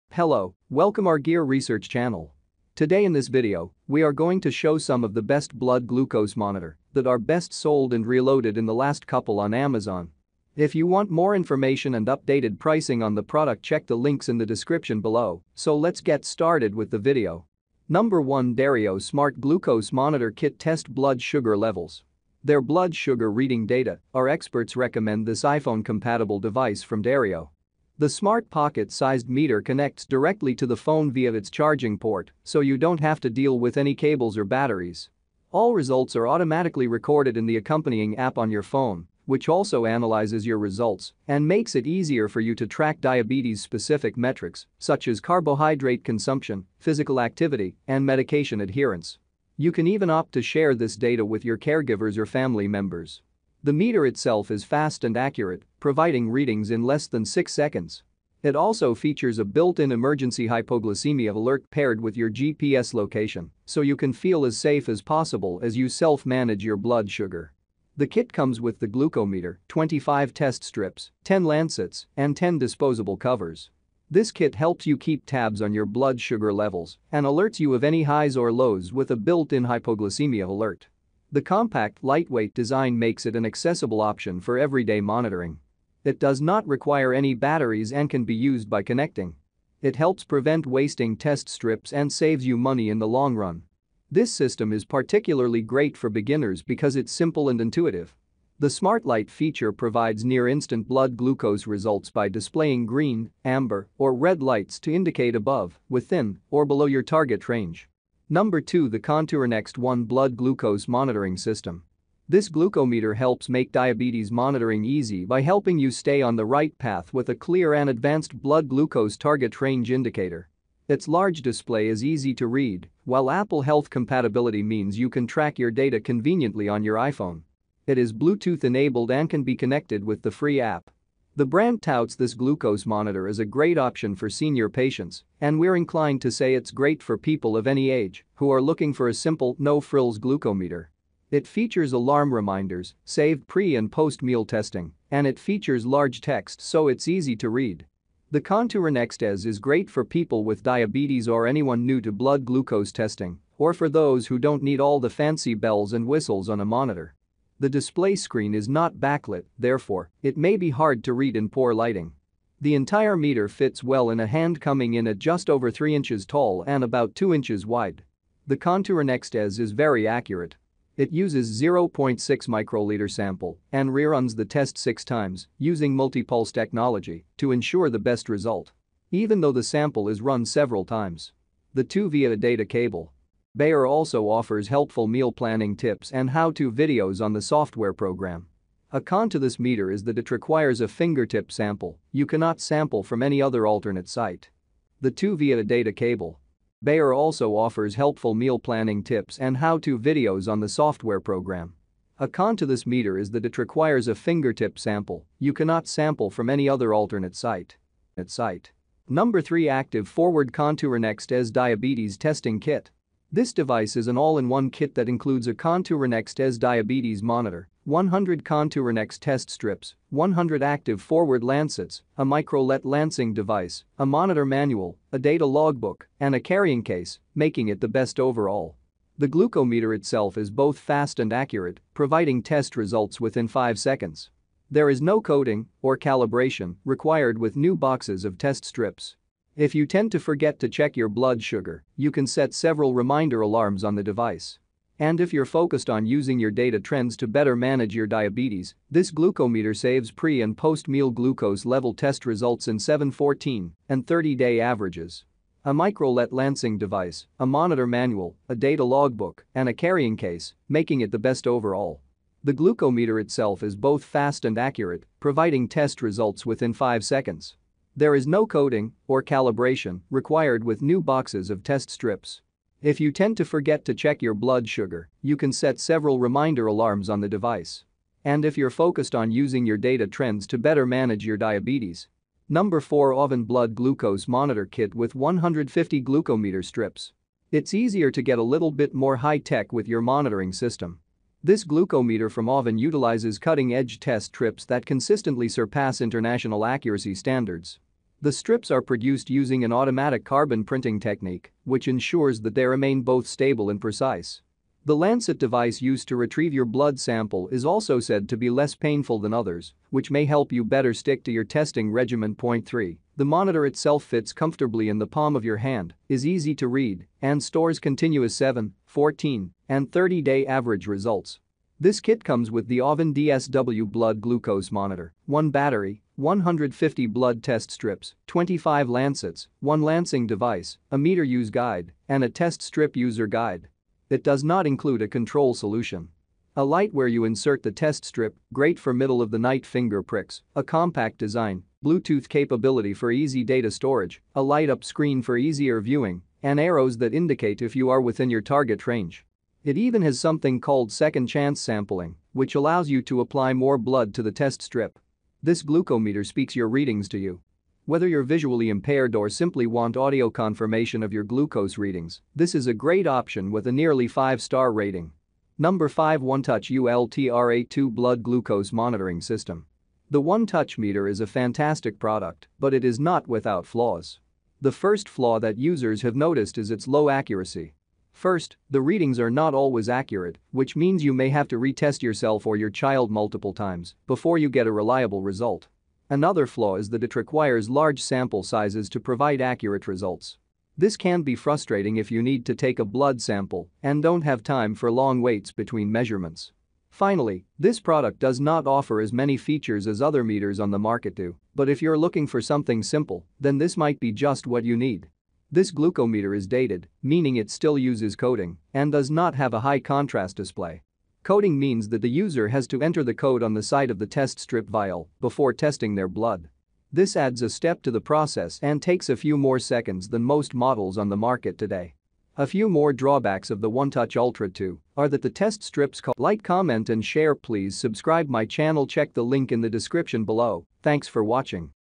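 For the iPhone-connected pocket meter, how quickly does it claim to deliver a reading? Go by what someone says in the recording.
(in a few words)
less than 6 seconds.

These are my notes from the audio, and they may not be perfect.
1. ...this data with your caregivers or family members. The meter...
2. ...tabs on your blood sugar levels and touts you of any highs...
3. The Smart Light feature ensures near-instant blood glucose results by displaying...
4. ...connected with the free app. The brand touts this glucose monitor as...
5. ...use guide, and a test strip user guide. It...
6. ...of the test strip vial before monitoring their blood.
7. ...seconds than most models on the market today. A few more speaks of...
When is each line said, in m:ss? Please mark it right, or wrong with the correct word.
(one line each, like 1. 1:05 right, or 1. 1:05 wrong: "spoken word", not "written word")
1. 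0:50 right
2. 1:15 wrong: "alerts", not "touts"
3. 1:38 wrong: "provides", not "ensures"
4. 2:09 right
5. 5:31 right
6. 6:53 wrong: "testing", not "monitoring"
7. 6:59 wrong: "drawbacks", not "speaks".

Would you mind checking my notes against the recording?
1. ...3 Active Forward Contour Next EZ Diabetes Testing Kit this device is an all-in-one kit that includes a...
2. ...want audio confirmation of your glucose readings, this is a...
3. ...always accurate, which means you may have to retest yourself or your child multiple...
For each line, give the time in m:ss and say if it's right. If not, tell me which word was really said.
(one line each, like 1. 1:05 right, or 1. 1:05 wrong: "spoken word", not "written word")
1. 3:29 right
2. 5:59 right
3. 6:19 right.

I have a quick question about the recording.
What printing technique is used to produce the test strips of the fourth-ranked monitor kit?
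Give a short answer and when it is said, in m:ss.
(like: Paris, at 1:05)
automatic carbon printing, at 4:59.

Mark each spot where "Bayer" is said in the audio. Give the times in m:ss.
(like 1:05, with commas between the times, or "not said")
3:03, 3:16.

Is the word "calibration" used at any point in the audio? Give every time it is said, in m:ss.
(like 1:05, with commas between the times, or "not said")
3:55, 4:29.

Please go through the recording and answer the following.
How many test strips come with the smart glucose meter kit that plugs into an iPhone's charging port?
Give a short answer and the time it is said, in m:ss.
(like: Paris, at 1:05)
25, at 1:09.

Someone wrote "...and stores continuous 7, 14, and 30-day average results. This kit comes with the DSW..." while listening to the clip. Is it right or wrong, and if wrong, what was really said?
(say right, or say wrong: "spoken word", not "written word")
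wrong: "AUVON", not "DSW".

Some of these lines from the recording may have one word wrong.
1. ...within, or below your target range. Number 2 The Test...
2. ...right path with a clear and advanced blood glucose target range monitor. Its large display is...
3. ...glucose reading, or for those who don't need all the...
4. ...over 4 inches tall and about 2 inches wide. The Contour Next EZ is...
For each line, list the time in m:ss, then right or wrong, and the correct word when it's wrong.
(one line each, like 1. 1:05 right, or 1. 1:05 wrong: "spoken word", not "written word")
1. 1:45 wrong: "Contour", not "Test"
2. 1:56 wrong: "indicator", not "monitor"
3. 2:32 wrong: "testing", not "reading"
4. 2:45 wrong: "3", not "4".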